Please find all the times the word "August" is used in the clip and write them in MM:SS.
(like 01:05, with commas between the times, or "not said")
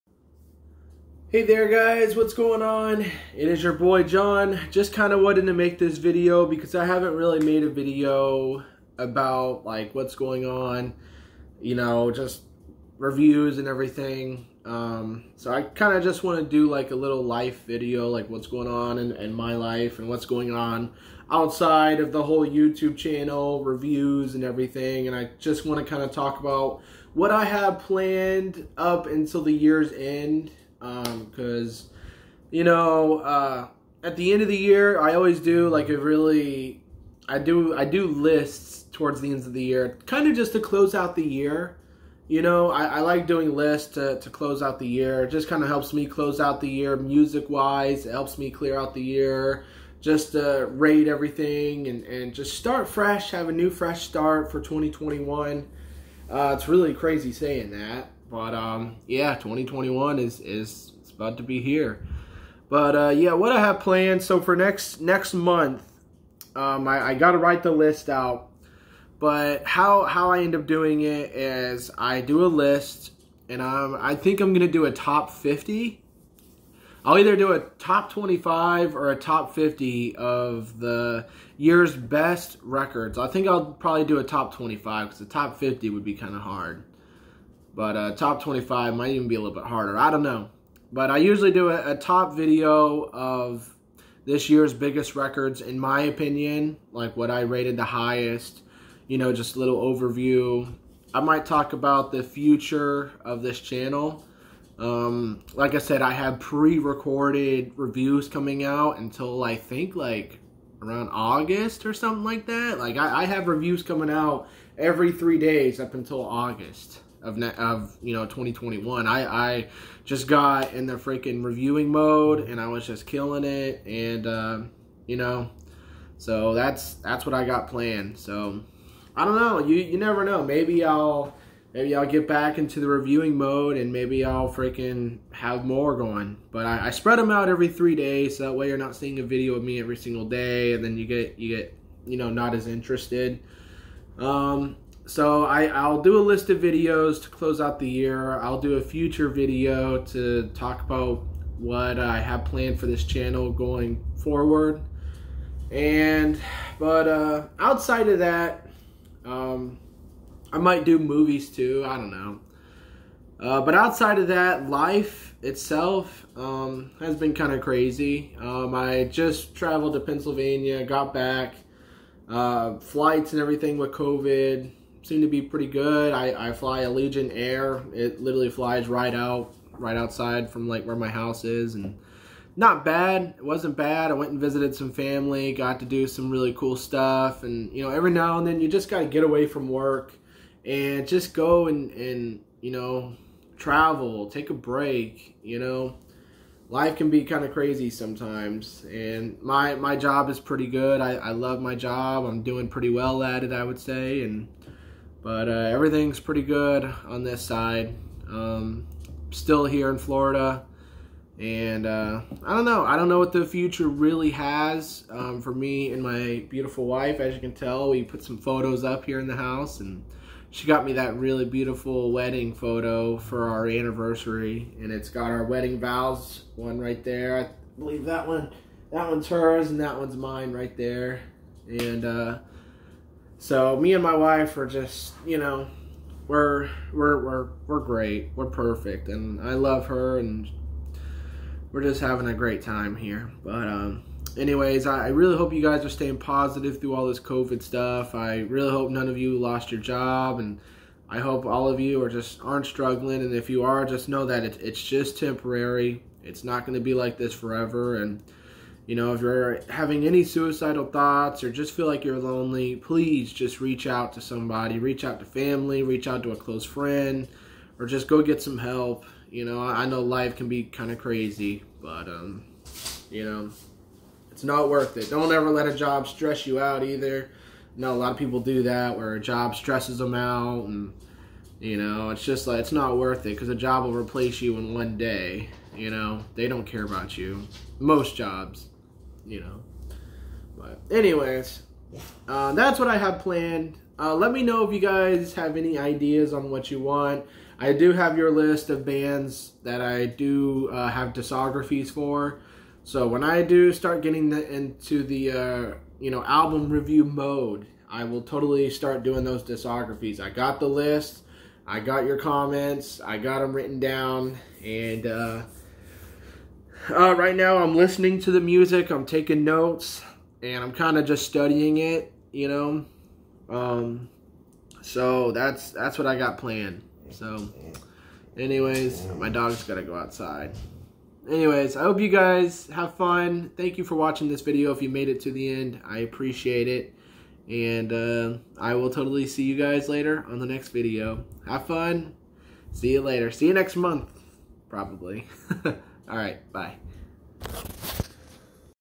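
01:51, 01:56.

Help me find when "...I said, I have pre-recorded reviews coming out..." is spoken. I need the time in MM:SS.
01:45.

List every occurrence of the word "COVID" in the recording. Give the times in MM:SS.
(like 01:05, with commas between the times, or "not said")
02:53, 04:07.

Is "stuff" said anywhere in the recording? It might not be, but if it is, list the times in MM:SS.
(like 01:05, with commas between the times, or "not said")
03:06, 04:07.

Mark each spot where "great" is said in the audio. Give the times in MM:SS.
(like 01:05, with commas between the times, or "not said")
03:57, 04:02.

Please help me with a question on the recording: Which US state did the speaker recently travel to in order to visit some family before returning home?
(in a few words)
Pennsylvania.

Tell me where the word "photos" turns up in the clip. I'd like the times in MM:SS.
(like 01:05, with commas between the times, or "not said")
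03:38, 03:42.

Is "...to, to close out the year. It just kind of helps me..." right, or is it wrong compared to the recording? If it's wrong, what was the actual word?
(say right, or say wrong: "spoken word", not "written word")
right.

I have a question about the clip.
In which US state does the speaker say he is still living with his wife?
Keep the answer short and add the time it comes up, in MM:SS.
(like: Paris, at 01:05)
Florida, at 03:29.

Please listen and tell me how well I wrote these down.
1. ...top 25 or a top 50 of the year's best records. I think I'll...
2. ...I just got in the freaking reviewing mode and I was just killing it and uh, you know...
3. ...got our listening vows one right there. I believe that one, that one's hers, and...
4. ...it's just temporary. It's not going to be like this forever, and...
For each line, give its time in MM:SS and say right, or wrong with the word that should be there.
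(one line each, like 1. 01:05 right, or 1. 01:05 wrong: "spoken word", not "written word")
1. 01:17 right
2. 01:59 right
3. 03:45 wrong: "wedding", not "listening"
4. 04:14 right.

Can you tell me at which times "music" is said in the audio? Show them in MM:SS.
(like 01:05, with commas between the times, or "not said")
00:46, 05:18.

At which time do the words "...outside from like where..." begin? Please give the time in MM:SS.
02:59.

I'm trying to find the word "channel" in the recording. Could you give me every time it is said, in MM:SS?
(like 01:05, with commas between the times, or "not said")
00:22, 01:43, 02:33.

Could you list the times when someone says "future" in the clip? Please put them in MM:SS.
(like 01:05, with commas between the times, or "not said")
01:42, 02:28, 03:33.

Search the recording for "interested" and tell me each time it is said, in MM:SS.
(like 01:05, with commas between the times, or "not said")
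02:22.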